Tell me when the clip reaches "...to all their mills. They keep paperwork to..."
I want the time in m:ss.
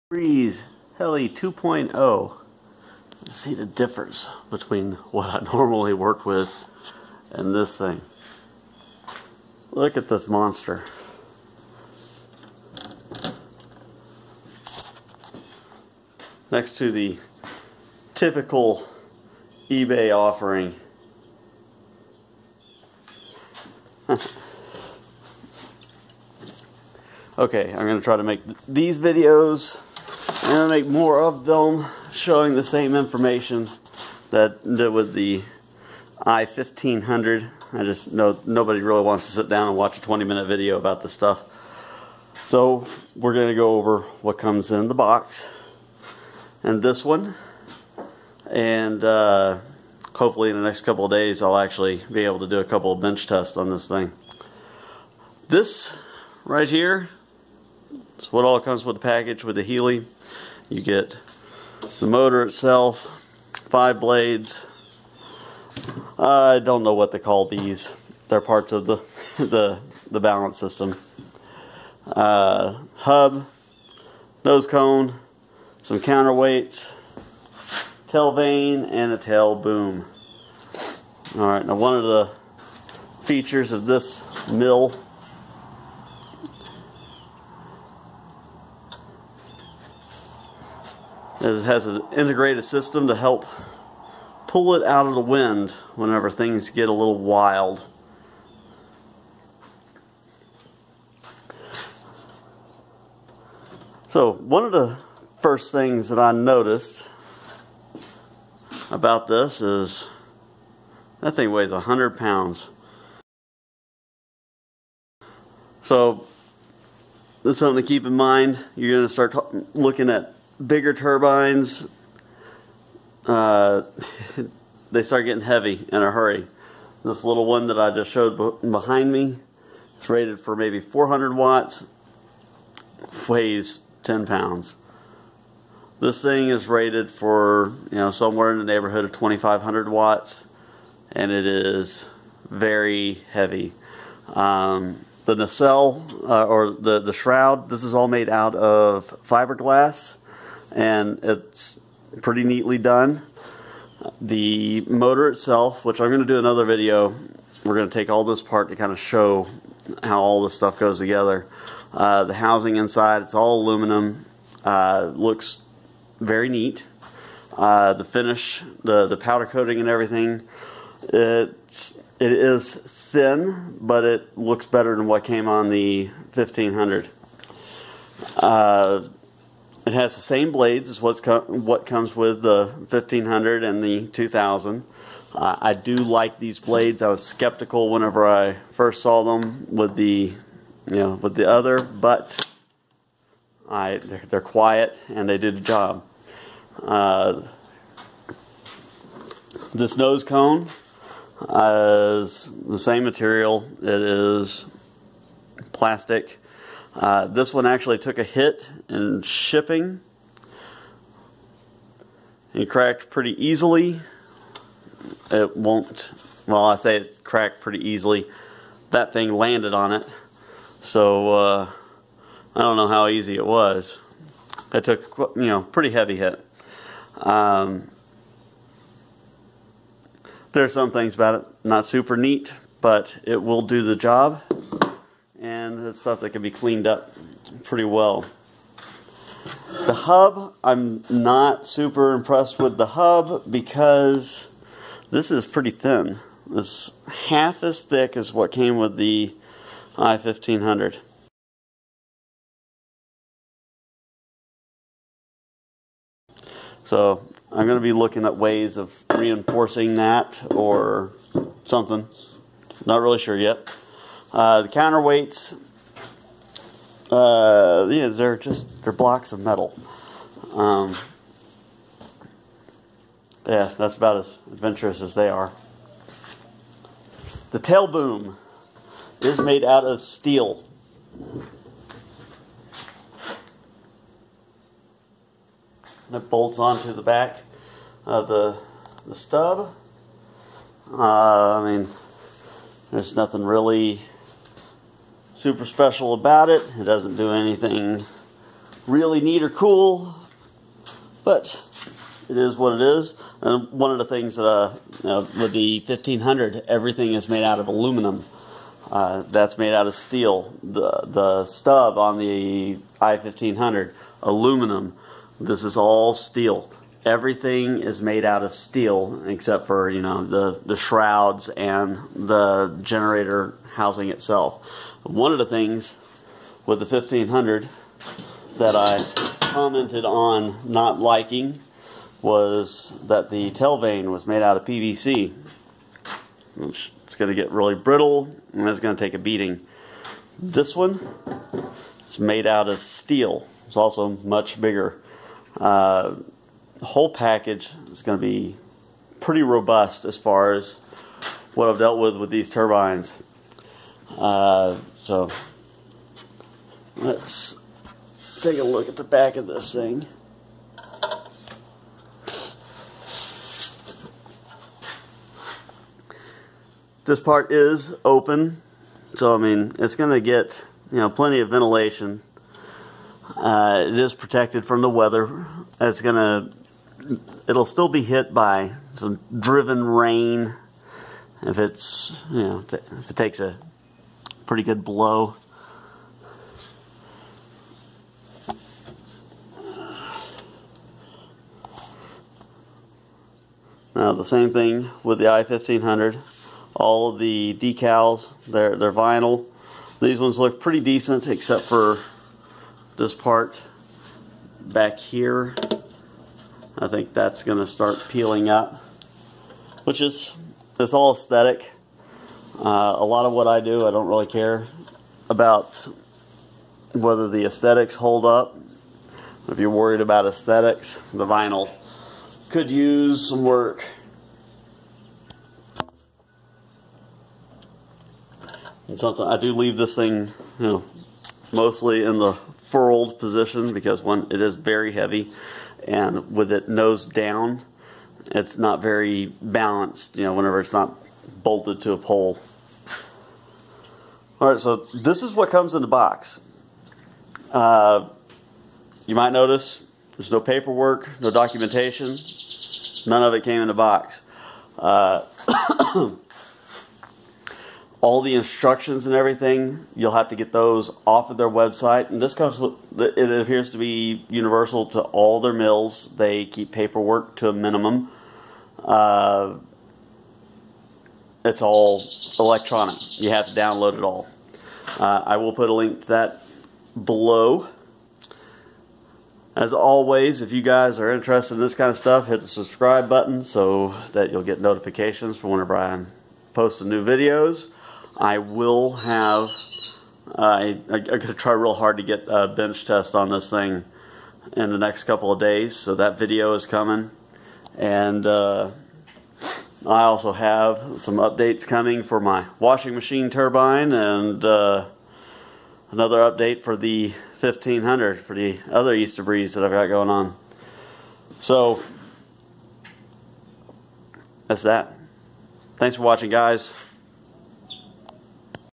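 7:44.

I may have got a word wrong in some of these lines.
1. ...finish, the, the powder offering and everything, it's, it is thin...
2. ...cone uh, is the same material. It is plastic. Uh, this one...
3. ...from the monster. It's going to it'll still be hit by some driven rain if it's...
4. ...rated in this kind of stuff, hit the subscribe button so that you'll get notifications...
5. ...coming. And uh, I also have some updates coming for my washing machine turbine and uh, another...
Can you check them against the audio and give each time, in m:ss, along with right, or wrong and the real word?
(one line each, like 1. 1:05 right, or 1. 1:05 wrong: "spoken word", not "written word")
1. 2:48 wrong: "coating", not "offering"
2. 3:20 right
3. 6:14 wrong: "weather", not "monster"
4. 8:01 wrong: "interested", not "rated"
5. 8:16 right.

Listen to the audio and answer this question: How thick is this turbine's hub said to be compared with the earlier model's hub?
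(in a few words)
Half as thick.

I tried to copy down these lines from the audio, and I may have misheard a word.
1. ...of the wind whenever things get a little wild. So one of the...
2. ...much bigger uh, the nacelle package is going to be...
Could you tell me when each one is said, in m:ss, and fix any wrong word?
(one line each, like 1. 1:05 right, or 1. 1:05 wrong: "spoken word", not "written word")
1. 1:35 right
2. 5:44 wrong: "whole", not "nacelle".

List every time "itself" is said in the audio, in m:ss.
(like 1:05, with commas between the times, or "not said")
1:02, 2:35, 5:24.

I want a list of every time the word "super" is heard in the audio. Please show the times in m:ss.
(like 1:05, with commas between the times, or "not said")
3:51, 4:01, 4:55.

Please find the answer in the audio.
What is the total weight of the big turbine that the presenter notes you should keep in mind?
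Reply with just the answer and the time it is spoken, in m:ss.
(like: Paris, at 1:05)
100 pounds, at 1:51.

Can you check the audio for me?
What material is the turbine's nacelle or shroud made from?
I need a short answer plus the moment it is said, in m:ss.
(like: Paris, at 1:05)
Fiberglass, at 2:29.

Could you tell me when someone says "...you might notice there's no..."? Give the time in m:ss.
7:29.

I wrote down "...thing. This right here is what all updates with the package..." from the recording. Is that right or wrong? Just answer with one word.
wrong.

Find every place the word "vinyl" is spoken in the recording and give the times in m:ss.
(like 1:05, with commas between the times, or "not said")
6:38, 7:01.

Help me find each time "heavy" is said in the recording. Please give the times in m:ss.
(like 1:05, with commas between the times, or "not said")
2:05, 2:23, 3:45, 7:14.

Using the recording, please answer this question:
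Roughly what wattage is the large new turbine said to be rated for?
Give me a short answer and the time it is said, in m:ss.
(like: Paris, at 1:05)
2,500 watts, at 2:19.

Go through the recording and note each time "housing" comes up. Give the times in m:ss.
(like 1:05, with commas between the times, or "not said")
2:42, 5:23.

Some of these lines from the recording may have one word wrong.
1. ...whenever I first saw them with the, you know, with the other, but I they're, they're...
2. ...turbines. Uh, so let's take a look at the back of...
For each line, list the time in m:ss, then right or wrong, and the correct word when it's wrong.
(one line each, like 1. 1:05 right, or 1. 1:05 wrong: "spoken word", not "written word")
1. 3:07 right
2. 5:52 right.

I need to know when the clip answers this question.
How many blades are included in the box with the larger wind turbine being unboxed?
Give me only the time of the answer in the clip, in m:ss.
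1:03.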